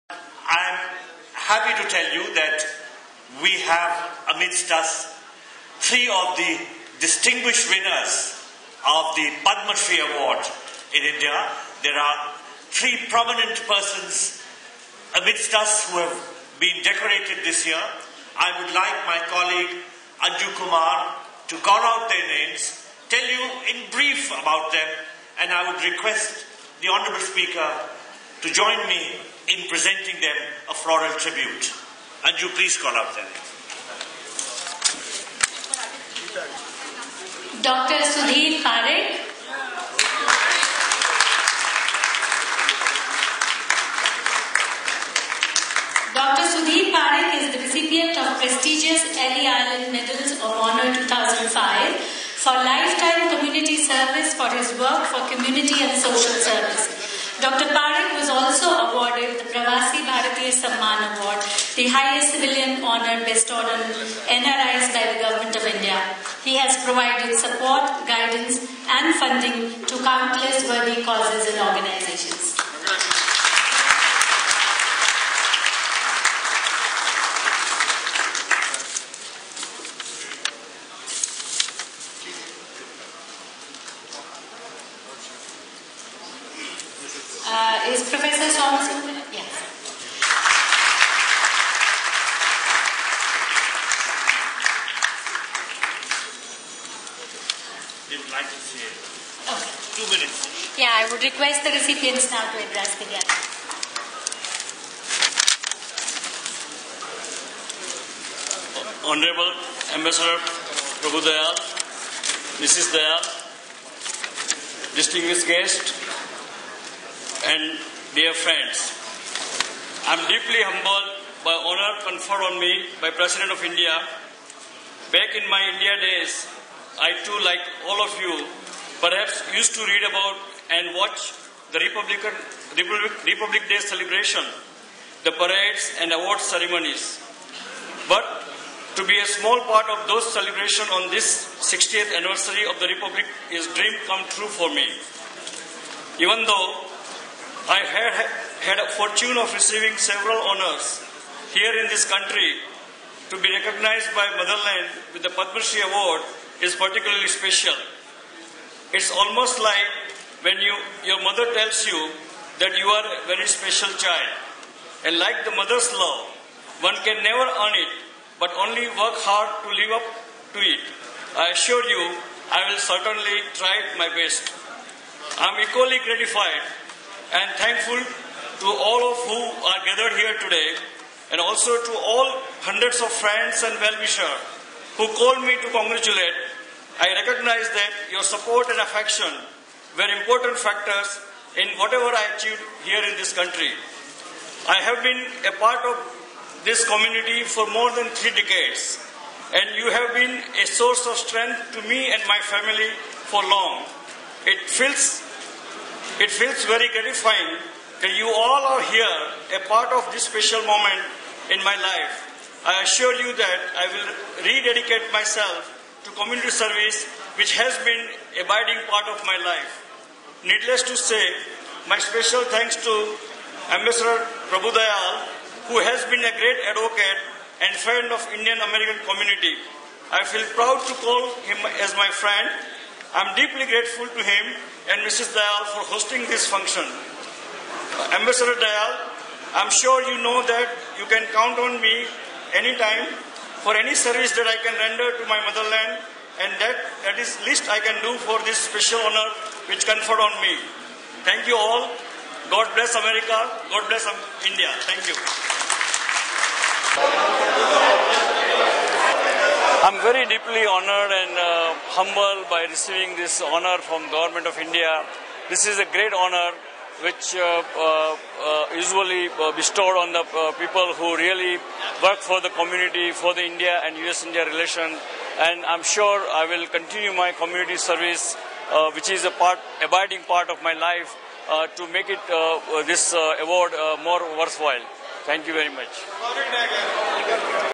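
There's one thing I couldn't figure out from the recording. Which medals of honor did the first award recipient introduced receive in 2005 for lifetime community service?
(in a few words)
Ellis Island Medals of Honor.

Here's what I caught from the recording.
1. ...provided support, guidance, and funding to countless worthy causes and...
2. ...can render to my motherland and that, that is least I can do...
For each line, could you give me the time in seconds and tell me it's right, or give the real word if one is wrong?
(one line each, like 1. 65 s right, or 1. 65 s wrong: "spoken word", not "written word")
1. 66 s right
2. 244 s right.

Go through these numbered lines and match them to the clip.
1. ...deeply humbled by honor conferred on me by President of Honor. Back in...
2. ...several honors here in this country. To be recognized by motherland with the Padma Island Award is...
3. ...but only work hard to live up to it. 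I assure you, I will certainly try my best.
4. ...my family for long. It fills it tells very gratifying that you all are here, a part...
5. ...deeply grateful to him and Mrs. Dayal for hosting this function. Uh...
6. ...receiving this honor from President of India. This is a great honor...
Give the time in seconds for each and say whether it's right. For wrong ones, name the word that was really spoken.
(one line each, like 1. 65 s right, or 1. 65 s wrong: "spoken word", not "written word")
1. 120 s wrong: "India", not "Honor"
2. 150 s wrong: "Shri", not "Island"
3. 168 s right
4. 202 s wrong: "feels", not "tells"
5. 233 s right
6. 262 s wrong: "Government", not "President".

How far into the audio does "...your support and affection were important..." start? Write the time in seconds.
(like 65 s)
188 s.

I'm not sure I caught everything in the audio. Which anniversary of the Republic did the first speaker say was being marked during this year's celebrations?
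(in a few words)
60th.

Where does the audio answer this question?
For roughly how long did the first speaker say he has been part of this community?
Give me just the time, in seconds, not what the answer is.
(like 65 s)
197 s.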